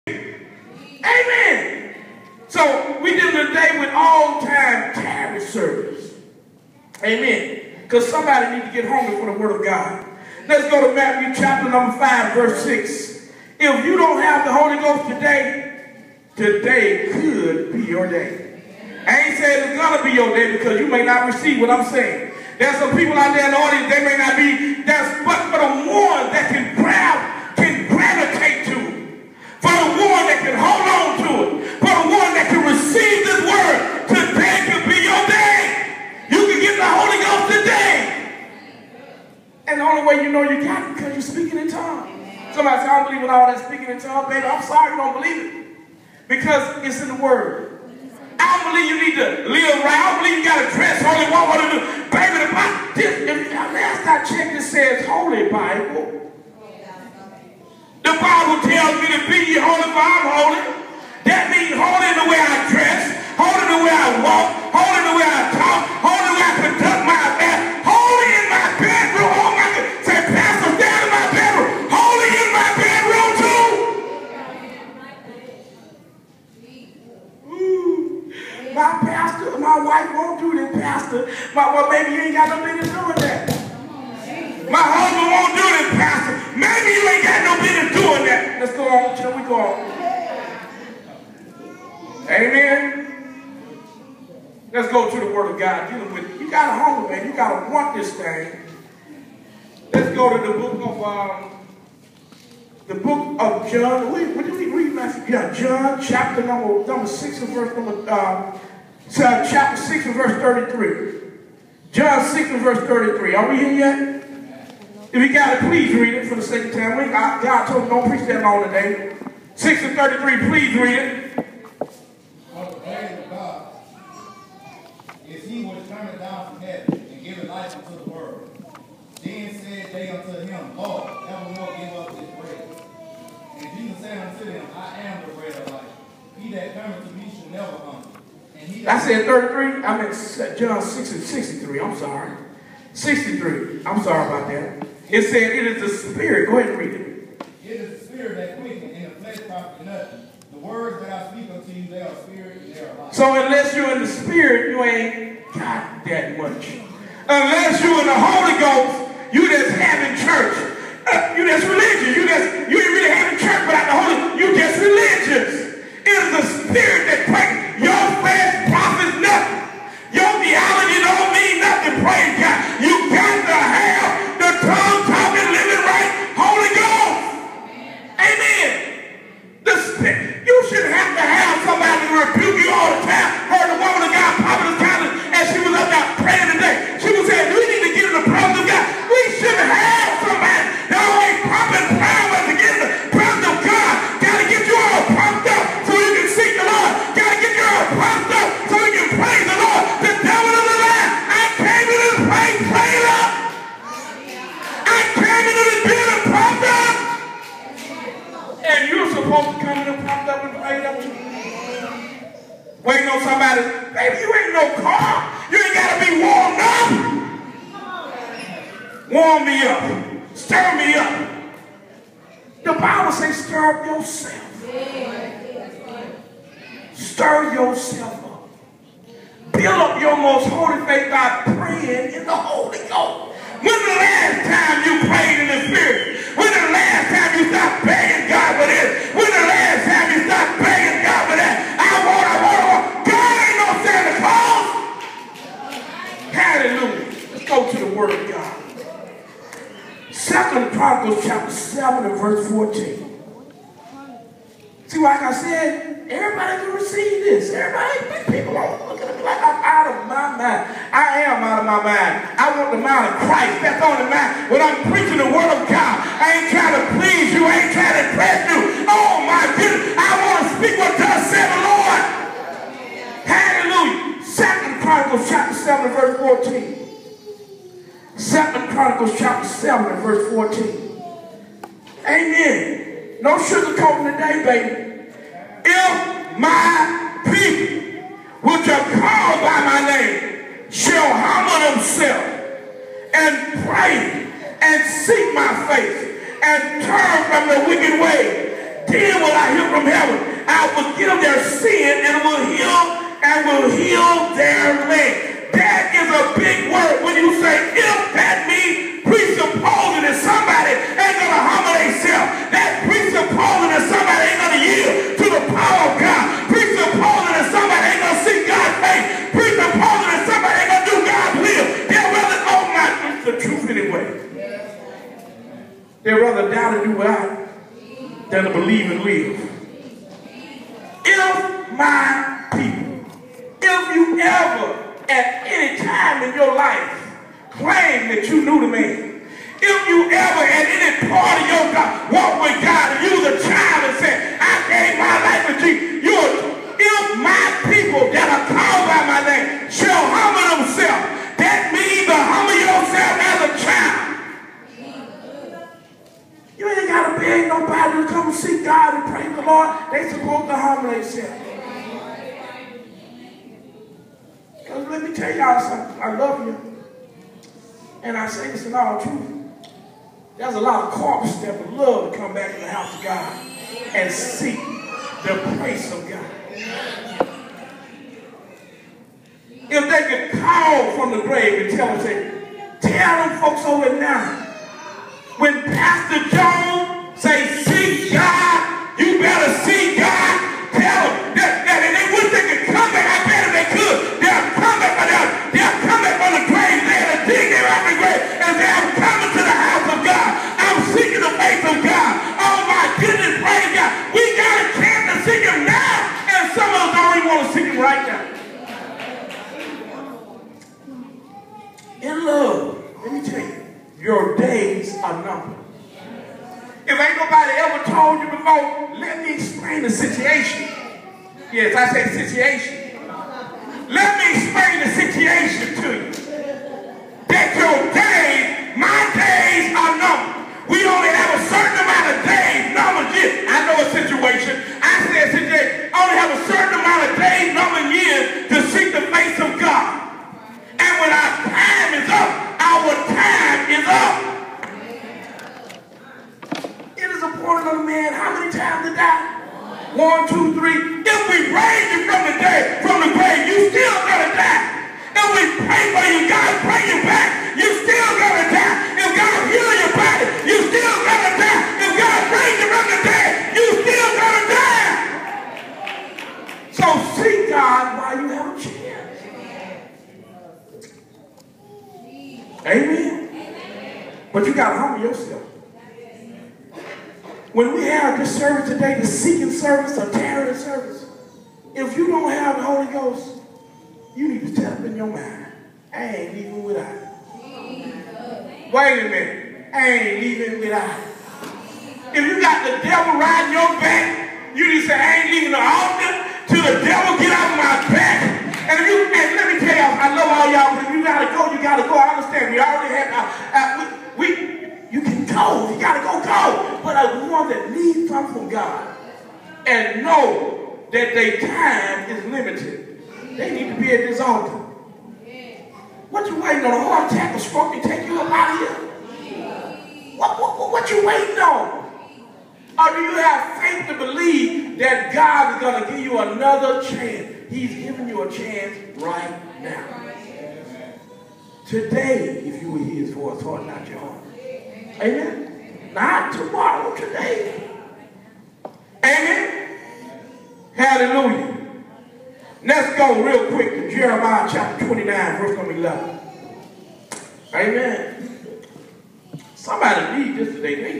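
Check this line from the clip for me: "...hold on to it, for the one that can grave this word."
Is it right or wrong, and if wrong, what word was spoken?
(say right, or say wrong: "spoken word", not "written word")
wrong: "receive", not "grave".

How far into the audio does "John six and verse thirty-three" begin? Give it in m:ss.
1:51.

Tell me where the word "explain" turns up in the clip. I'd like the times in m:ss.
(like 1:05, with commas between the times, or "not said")
6:59, 7:04.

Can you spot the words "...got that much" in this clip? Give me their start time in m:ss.
2:35.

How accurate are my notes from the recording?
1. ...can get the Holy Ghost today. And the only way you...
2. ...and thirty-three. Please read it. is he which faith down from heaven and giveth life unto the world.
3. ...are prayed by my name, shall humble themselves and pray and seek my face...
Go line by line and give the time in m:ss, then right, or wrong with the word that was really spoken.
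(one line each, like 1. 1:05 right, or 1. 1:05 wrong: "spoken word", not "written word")
1. 0:36 right
2. 1:59 wrong: "turneth", not "faith"
3. 4:48 wrong: "called", not "prayed".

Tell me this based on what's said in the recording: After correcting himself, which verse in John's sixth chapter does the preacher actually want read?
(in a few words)
John 6:63.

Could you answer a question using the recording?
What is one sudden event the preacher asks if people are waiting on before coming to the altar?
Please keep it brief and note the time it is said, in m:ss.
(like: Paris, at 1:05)
A heart attack, at 8:36.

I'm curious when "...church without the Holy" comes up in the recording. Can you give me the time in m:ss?
2:43.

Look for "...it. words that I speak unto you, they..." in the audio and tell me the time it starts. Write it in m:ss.
2:27.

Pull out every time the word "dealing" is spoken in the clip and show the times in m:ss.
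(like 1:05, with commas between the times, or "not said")
0:03, 1:35.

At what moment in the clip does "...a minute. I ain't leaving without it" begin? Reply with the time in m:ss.
8:09.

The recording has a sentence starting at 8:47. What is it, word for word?
He's giving you a chance right now.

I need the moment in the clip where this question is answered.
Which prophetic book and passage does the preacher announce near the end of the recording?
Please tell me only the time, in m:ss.
9:03.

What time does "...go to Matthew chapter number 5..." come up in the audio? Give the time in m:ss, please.
0:10.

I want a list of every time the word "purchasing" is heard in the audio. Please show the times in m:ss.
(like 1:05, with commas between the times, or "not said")
not said.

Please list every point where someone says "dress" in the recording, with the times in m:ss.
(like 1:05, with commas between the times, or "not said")
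0:50, 1:02.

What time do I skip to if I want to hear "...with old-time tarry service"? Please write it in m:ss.
0:03.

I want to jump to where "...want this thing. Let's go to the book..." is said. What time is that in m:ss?
1:37.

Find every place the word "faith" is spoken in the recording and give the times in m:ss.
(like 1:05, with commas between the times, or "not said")
3:50, 8:43.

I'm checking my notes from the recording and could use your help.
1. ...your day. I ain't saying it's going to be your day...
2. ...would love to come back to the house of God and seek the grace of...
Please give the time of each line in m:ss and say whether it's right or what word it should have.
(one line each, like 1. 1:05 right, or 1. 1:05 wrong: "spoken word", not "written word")
1. 0:17 right
2. 6:11 right.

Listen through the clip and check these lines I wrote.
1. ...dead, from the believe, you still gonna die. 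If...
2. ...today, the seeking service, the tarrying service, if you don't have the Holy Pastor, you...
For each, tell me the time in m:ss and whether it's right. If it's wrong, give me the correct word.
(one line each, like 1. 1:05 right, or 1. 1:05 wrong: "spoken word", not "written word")
1. 7:32 wrong: "grave", not "believe"
2. 7:58 wrong: "Ghost", not "Pastor".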